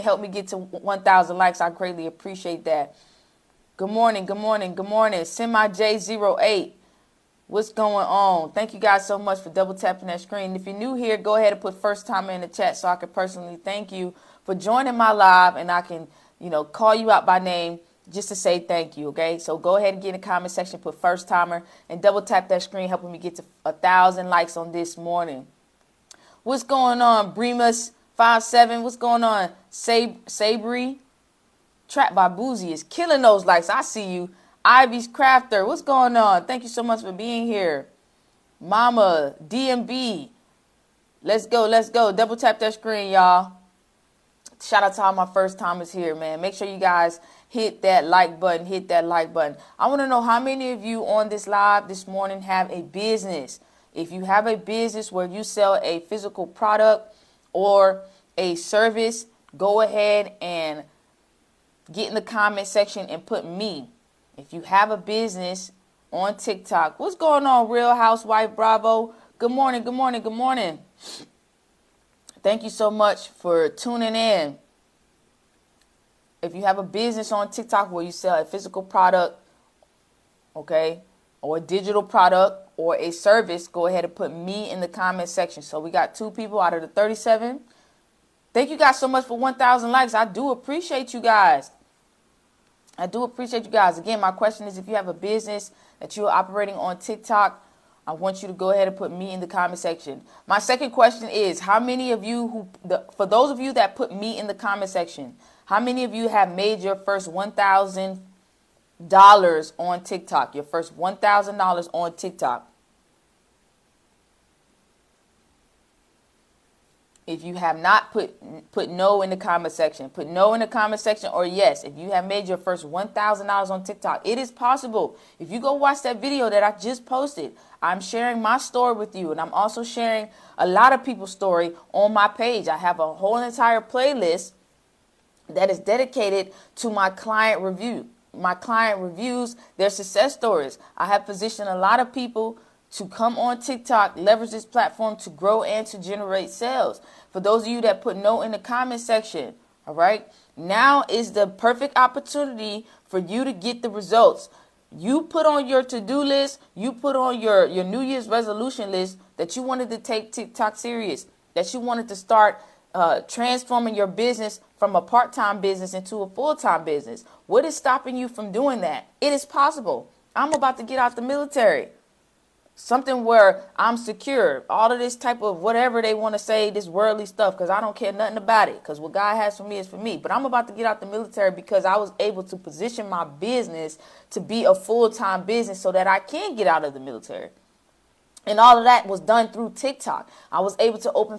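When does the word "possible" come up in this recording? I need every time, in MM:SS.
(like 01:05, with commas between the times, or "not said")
02:04, 02:49.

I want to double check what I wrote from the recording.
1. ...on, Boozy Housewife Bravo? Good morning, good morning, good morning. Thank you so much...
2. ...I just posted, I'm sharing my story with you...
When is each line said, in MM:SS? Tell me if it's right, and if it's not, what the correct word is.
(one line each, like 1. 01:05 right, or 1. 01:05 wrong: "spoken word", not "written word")
1. 01:07 wrong: "Real", not "Boozy"
2. 02:06 right.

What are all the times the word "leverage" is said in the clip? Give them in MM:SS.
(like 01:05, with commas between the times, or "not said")
02:24.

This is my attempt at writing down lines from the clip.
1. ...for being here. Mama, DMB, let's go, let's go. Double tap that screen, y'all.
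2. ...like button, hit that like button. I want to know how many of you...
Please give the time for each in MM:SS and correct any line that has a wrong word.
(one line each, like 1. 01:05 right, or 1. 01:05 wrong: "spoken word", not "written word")
1. 00:37 right
2. 00:48 right.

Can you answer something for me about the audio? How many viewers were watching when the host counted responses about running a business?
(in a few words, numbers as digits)
37.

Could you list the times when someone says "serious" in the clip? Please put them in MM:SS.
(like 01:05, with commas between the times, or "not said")
02:40.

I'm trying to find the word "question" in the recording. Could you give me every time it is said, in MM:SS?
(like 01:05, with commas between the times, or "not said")
01:34, 01:40.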